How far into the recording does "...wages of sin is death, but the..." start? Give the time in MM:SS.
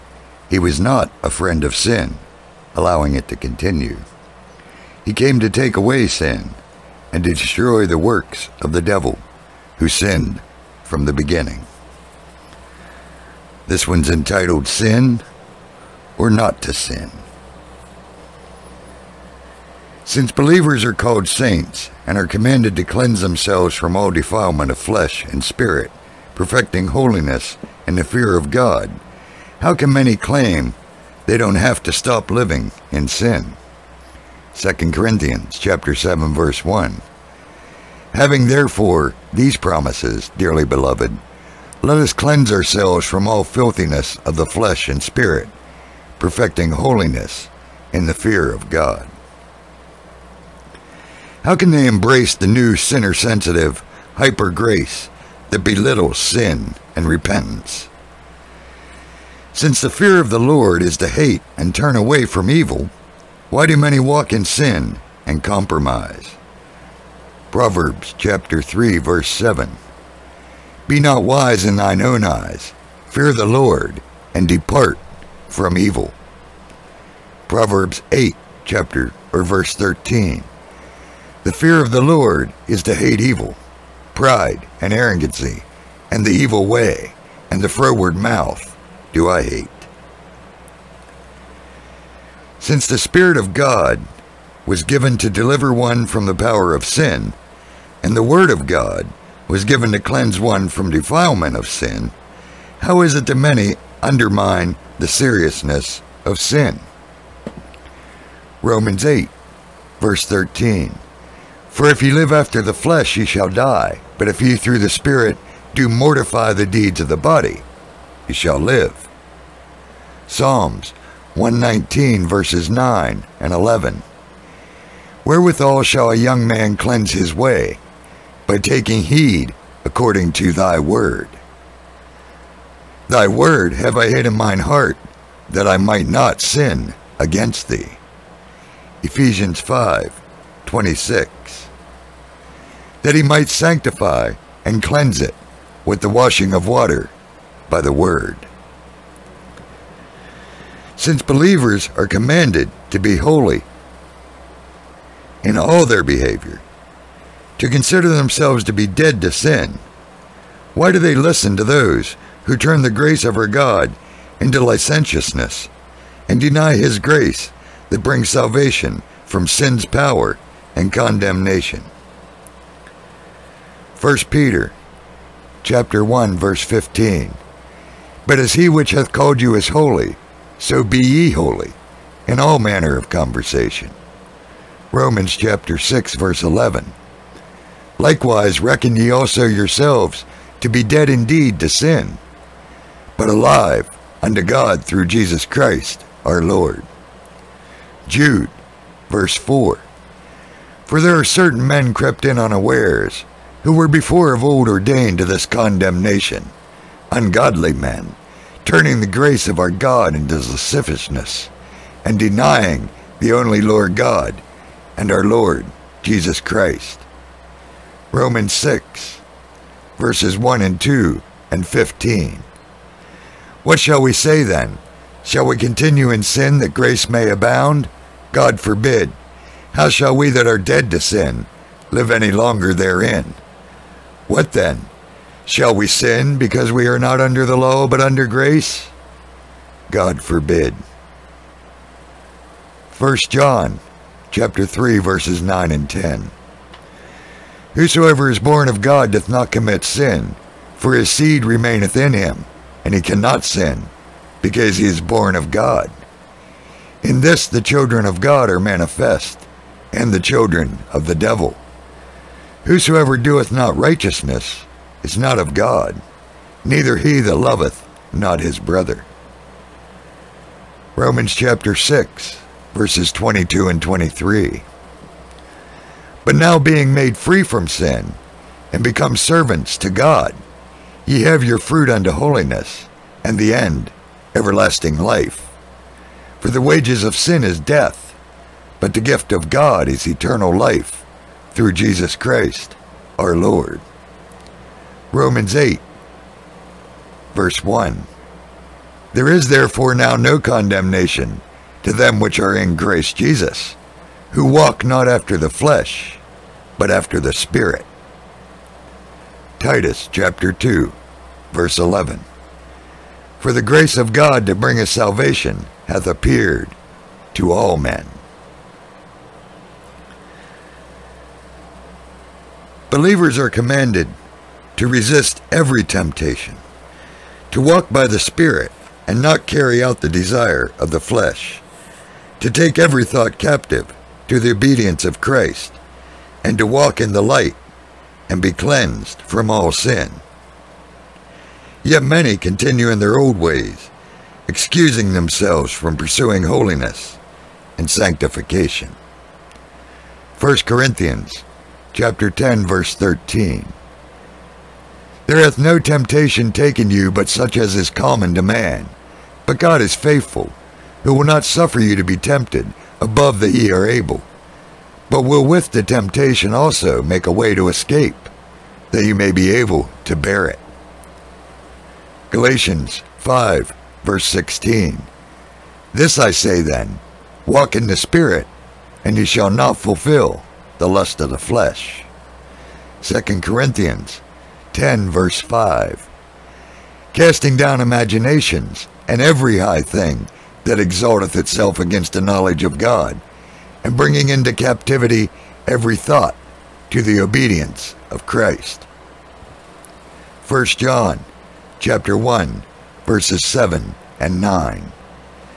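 04:46.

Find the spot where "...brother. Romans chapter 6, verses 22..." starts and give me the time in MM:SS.
04:28.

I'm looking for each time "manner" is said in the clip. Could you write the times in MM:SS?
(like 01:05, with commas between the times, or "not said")
03:02.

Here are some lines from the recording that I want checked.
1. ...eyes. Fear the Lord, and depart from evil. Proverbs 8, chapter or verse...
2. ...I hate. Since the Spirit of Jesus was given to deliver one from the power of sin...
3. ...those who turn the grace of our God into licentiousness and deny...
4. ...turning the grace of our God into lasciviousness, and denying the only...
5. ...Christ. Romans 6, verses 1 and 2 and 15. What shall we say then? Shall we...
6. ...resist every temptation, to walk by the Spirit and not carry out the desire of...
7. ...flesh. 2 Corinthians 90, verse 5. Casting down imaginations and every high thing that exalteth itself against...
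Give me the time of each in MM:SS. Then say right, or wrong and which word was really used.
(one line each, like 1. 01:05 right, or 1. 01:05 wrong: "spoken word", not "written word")
1. 01:12 right
2. 01:29 wrong: "God", not "Jesus"
3. 02:41 right
4. 03:28 right
5. 03:36 right
6. 05:24 right
7. 06:21 wrong: "10", not "90".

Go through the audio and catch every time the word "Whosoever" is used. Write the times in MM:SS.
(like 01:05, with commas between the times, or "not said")
04:07, 04:22.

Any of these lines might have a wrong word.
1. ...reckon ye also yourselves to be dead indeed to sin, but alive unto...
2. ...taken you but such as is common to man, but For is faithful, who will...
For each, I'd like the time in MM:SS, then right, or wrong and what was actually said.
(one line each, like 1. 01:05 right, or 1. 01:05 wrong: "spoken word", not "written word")
1. 03:08 right
2. 05:56 wrong: "God", not "For".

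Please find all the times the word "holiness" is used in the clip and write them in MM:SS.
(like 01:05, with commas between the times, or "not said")
00:26, 00:46, 04:42, 05:46.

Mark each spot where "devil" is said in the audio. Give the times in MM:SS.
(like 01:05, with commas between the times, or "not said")
00:08, 04:21.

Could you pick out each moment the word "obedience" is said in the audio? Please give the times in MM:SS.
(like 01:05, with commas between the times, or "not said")
05:34, 06:37.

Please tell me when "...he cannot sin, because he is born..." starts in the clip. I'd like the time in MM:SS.
04:12.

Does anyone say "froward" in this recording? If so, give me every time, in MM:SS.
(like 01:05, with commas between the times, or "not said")
01:27.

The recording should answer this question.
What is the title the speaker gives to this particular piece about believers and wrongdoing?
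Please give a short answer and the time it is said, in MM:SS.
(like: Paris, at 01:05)
Sin or Not to Sin, at 00:14.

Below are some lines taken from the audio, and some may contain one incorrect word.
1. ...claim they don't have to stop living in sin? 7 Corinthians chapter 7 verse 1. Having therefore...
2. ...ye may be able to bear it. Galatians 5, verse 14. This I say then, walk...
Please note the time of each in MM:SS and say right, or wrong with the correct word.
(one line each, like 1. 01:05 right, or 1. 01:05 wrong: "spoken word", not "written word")
1. 00:30 wrong: "2", not "7"
2. 06:09 wrong: "16", not "14".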